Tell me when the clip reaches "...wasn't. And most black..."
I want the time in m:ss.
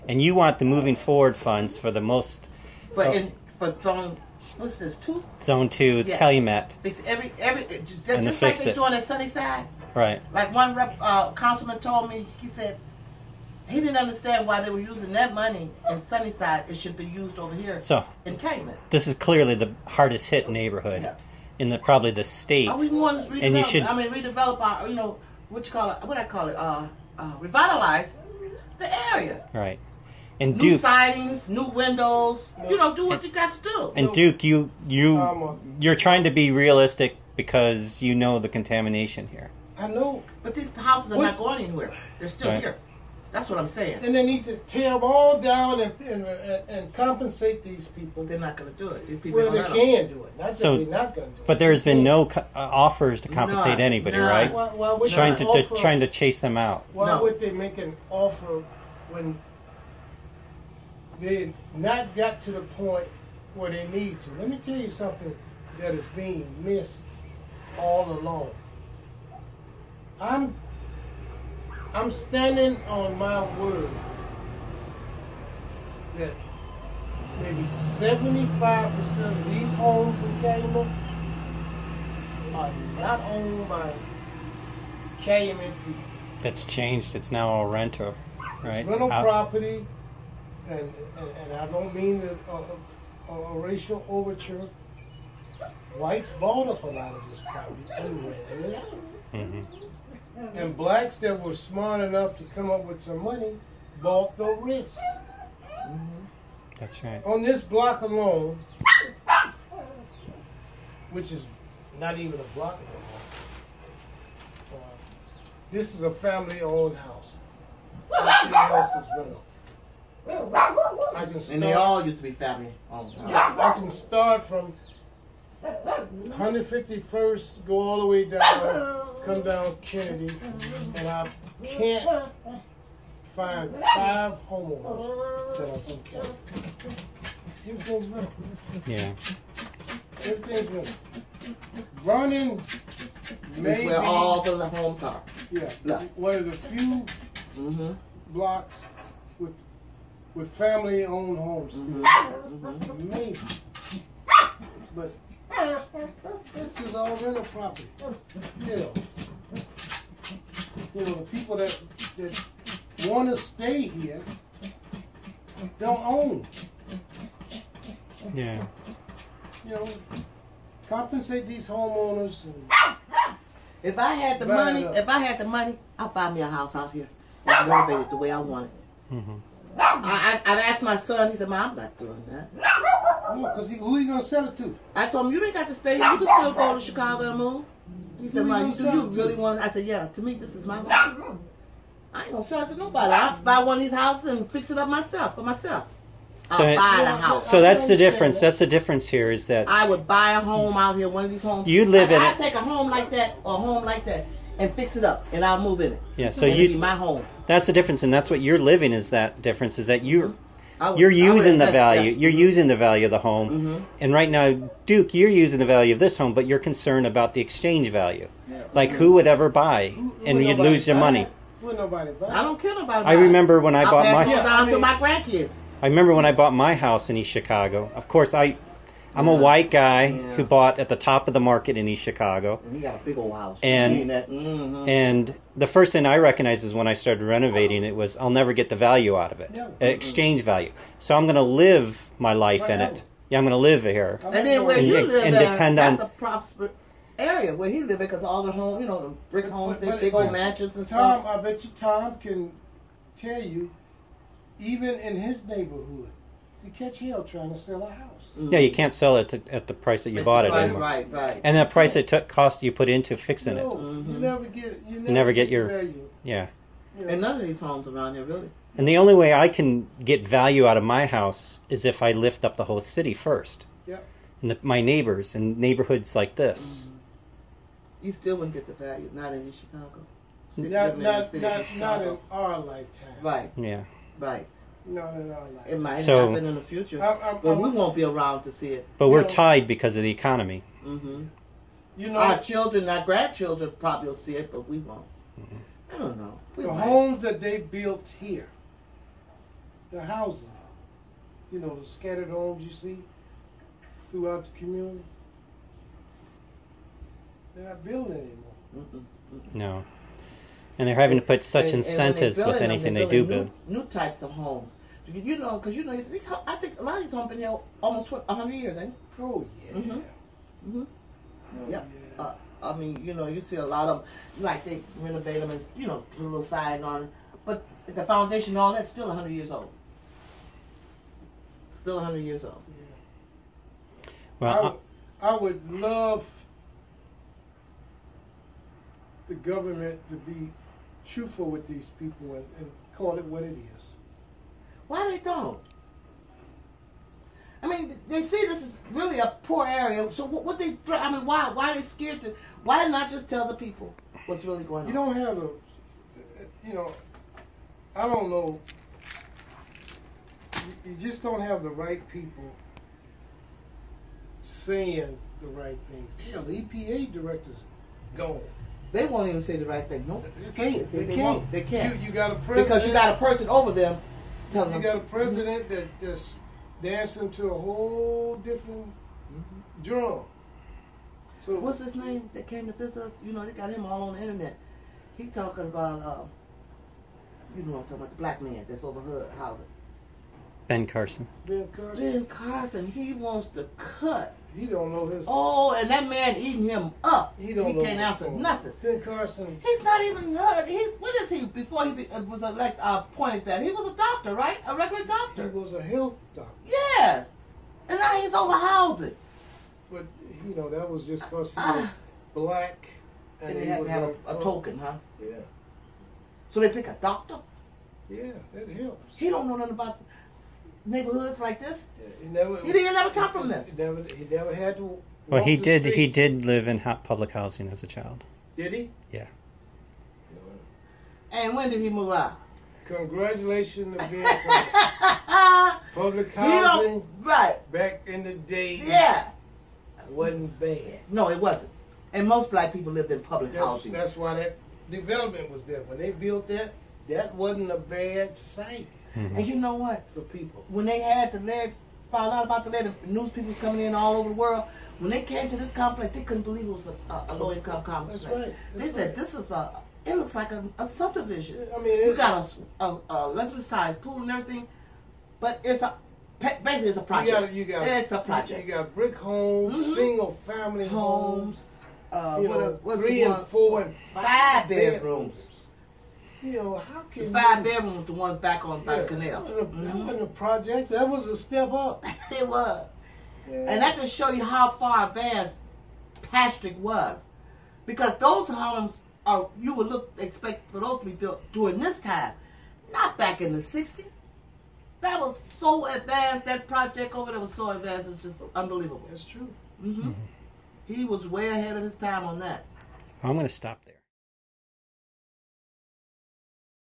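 7:21.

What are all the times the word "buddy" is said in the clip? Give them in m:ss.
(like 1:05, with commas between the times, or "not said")
not said.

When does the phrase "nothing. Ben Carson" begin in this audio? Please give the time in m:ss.
6:38.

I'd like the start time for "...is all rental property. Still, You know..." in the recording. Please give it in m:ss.
2:36.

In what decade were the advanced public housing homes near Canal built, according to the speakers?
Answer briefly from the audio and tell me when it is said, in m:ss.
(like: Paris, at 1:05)
the '60s, at 8:13.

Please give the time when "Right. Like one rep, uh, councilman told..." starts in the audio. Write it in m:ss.
0:09.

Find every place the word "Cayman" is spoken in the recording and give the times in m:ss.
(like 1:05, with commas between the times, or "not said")
1:20, 1:25.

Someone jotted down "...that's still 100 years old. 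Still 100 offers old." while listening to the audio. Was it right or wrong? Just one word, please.
wrong.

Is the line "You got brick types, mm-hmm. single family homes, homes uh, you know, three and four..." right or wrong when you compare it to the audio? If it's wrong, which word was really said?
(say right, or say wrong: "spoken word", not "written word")
wrong: "homes", not "types".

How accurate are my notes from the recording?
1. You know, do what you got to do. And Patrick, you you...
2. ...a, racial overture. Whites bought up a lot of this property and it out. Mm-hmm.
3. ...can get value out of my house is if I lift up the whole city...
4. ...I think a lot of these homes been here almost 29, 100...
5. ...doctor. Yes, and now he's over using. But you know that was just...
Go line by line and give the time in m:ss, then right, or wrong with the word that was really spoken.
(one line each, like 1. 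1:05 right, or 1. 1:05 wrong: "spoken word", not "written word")
1. 0:32 wrong: "Duke", not "Patrick"
2. 1:33 right
3. 4:29 right
4. 5:16 wrong: "20", not "29"
5. 6:46 wrong: "housing", not "using".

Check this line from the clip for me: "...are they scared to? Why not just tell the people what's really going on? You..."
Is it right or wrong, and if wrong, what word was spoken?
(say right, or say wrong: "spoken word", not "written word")
right.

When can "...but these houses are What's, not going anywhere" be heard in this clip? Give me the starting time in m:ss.
0:40.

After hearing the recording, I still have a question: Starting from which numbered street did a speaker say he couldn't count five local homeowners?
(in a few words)
151st.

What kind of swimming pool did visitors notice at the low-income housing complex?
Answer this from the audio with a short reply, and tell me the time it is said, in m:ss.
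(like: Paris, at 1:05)
Olympic sized, at 7:43.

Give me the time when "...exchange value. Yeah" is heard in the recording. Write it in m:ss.
3:37.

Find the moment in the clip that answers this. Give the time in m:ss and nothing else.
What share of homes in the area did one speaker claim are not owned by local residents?
1:17.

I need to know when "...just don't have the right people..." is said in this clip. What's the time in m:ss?
6:00.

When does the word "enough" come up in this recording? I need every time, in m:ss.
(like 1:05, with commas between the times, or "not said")
1:42.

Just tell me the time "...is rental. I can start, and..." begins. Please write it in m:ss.
1:59.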